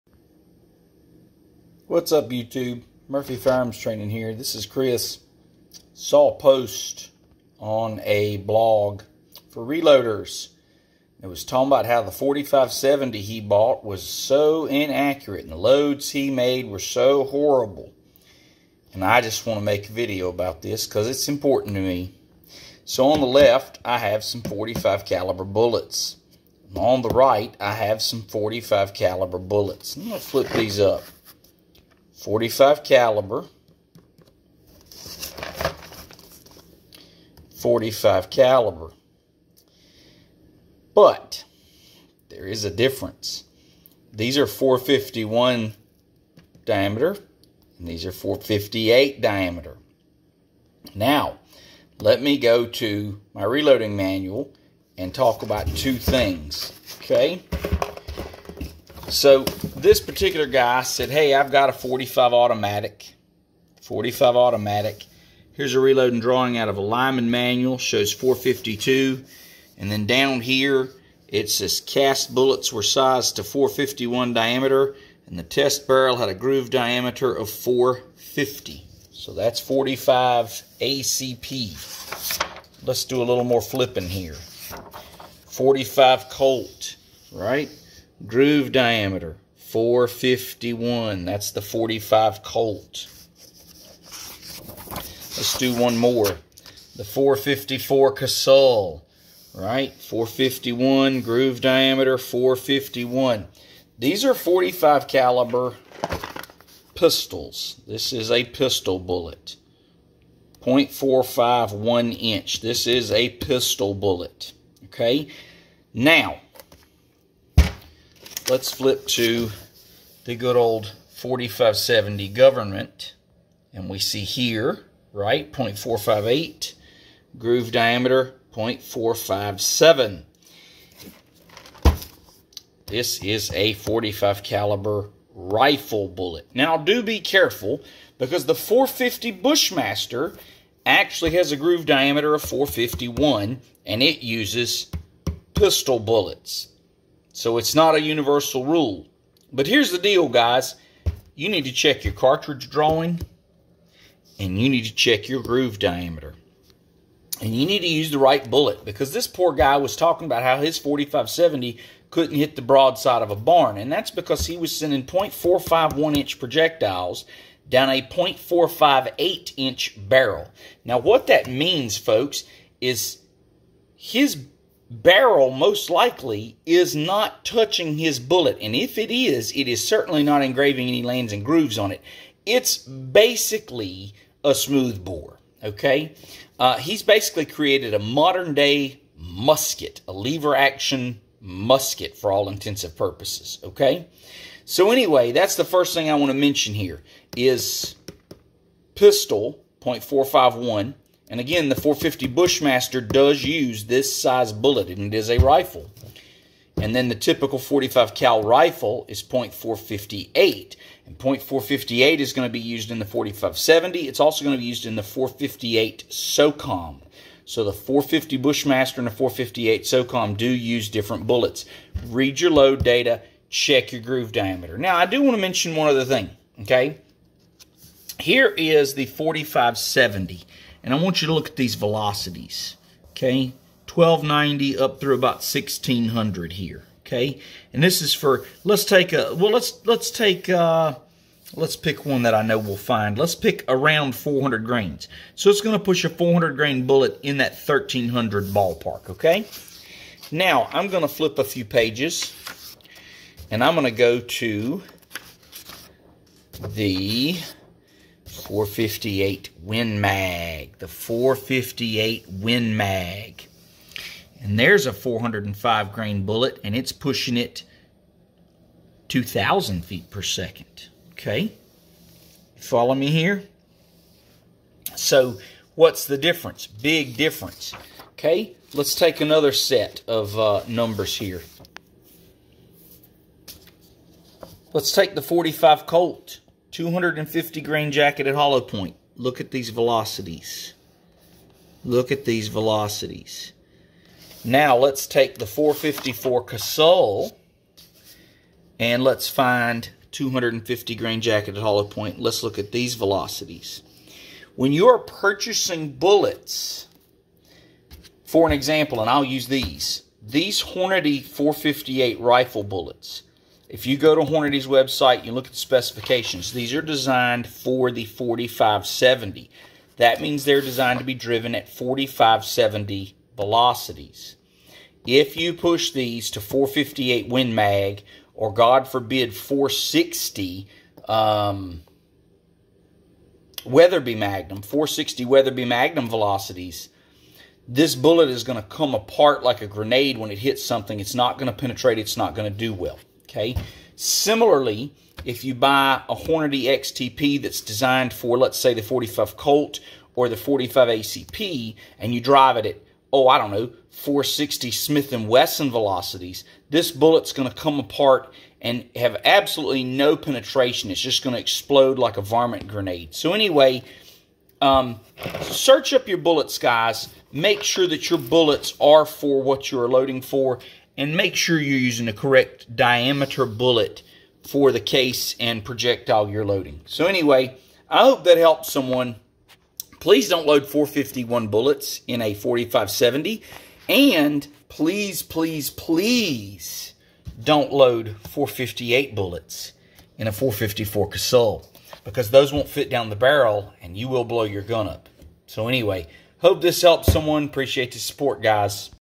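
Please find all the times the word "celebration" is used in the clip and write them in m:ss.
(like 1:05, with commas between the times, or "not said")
not said.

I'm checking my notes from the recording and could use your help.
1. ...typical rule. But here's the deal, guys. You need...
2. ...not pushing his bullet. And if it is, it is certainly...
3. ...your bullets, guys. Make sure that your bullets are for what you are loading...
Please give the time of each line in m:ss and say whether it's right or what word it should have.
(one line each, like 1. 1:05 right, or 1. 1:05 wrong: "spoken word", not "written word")
1. 2:28 wrong: "universal", not "typical"
2. 2:56 wrong: "touching", not "pushing"
3. 6:06 right.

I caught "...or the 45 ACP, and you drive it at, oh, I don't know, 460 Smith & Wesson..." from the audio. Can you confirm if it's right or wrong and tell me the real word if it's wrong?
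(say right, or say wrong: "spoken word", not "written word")
right.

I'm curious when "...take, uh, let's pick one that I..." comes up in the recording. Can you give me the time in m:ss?
4:00.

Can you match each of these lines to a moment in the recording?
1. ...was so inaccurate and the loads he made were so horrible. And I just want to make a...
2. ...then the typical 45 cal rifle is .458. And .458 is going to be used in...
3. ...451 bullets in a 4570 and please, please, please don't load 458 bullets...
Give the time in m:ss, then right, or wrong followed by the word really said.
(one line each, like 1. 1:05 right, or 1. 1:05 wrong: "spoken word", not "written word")
1. 0:13 right
2. 3:26 right
3. 6:20 right.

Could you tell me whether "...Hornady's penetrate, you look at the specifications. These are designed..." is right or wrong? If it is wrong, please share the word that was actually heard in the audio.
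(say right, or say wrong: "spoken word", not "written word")
wrong: "website", not "penetrate".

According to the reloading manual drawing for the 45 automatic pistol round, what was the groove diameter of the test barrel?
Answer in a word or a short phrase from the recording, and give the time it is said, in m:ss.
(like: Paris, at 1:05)
450, at 1:16.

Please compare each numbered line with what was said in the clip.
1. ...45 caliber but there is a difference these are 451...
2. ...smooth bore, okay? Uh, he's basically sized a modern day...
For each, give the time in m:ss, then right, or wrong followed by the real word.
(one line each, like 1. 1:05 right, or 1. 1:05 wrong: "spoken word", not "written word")
1. 0:37 right
2. 3:04 wrong: "created", not "sized".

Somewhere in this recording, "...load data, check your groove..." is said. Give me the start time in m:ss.
3:42.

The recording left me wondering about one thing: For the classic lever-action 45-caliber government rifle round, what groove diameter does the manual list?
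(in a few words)
0.457.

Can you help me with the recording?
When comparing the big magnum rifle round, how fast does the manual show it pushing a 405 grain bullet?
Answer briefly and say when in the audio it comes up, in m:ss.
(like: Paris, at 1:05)
2,000 feet per second, at 4:29.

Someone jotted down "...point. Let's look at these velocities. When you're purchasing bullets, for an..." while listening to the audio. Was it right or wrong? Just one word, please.
right.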